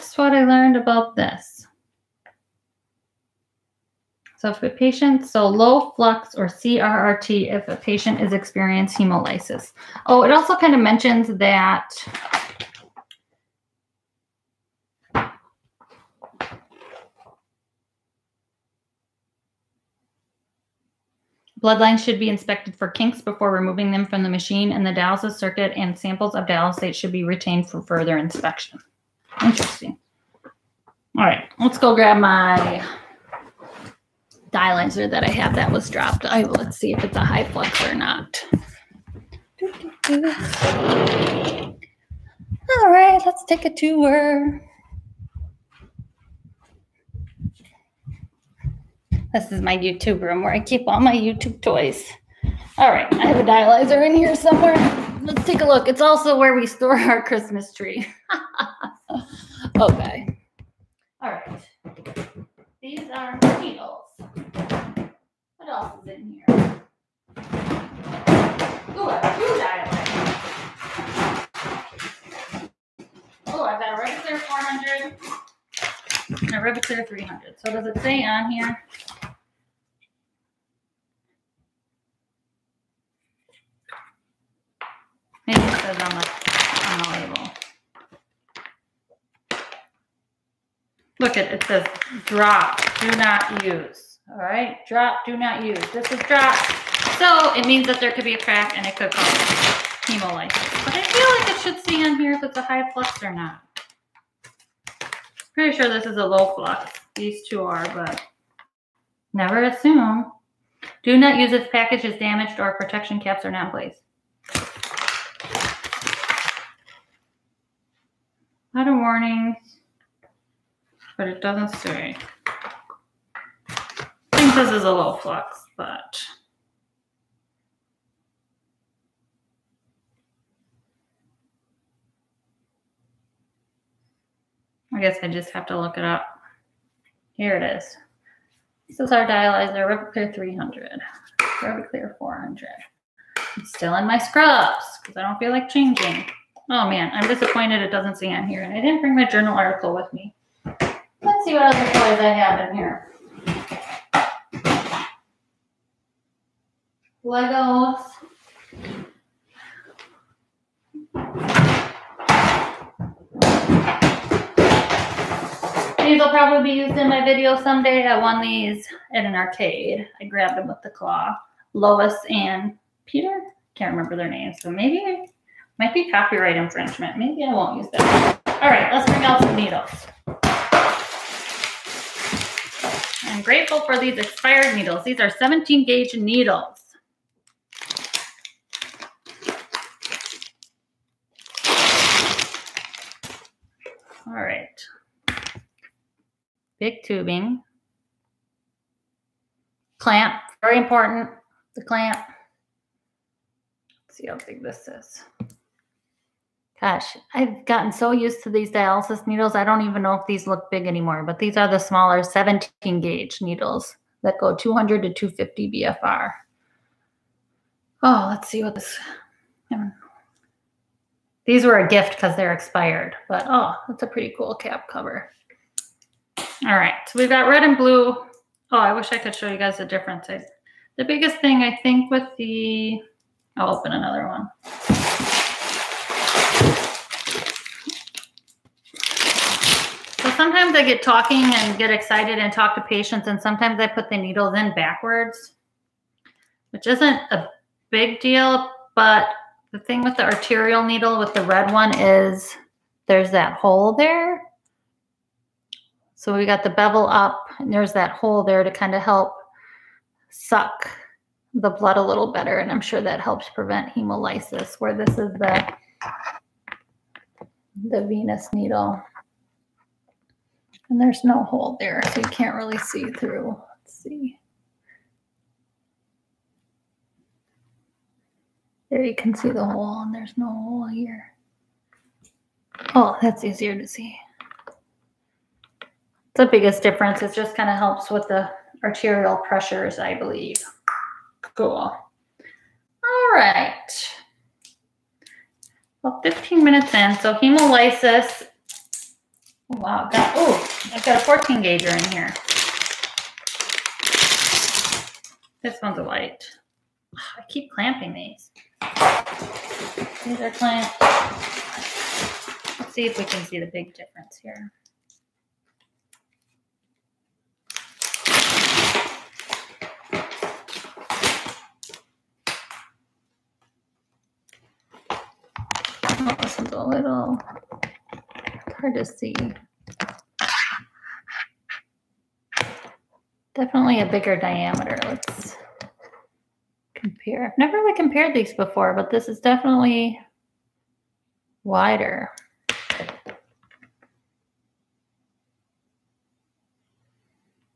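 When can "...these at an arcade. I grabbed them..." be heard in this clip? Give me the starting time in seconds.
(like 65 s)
168 s.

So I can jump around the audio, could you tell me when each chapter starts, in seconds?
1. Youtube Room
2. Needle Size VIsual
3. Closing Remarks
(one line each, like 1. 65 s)
1. 37 s
2. 177 s
3. 322 s.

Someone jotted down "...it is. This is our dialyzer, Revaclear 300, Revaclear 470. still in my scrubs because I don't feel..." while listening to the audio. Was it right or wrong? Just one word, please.
wrong.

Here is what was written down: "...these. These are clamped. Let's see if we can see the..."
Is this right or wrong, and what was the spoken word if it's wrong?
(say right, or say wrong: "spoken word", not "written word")
right.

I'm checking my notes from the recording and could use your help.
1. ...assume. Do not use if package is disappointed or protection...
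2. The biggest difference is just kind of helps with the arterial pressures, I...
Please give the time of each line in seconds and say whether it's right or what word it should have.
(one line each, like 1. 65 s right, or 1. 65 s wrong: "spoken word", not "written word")
1. 109 s wrong: "damaged", not "disappointed"
2. 286 s right.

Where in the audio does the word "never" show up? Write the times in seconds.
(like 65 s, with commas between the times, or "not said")
109 s, 337 s.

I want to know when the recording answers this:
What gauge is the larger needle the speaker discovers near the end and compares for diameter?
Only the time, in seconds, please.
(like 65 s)
301 s.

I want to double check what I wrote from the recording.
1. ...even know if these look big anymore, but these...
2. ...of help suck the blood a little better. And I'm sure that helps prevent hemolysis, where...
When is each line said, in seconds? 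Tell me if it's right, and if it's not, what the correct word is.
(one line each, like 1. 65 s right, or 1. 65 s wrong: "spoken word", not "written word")
1. 209 s right
2. 258 s right.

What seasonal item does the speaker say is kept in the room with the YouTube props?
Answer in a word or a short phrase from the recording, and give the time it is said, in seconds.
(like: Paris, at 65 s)
Christmas tree, at 57 s.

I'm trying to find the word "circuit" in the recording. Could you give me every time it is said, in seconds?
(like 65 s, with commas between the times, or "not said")
25 s.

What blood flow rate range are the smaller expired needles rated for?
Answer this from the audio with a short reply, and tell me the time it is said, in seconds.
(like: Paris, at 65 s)
200 to 250, at 214 s.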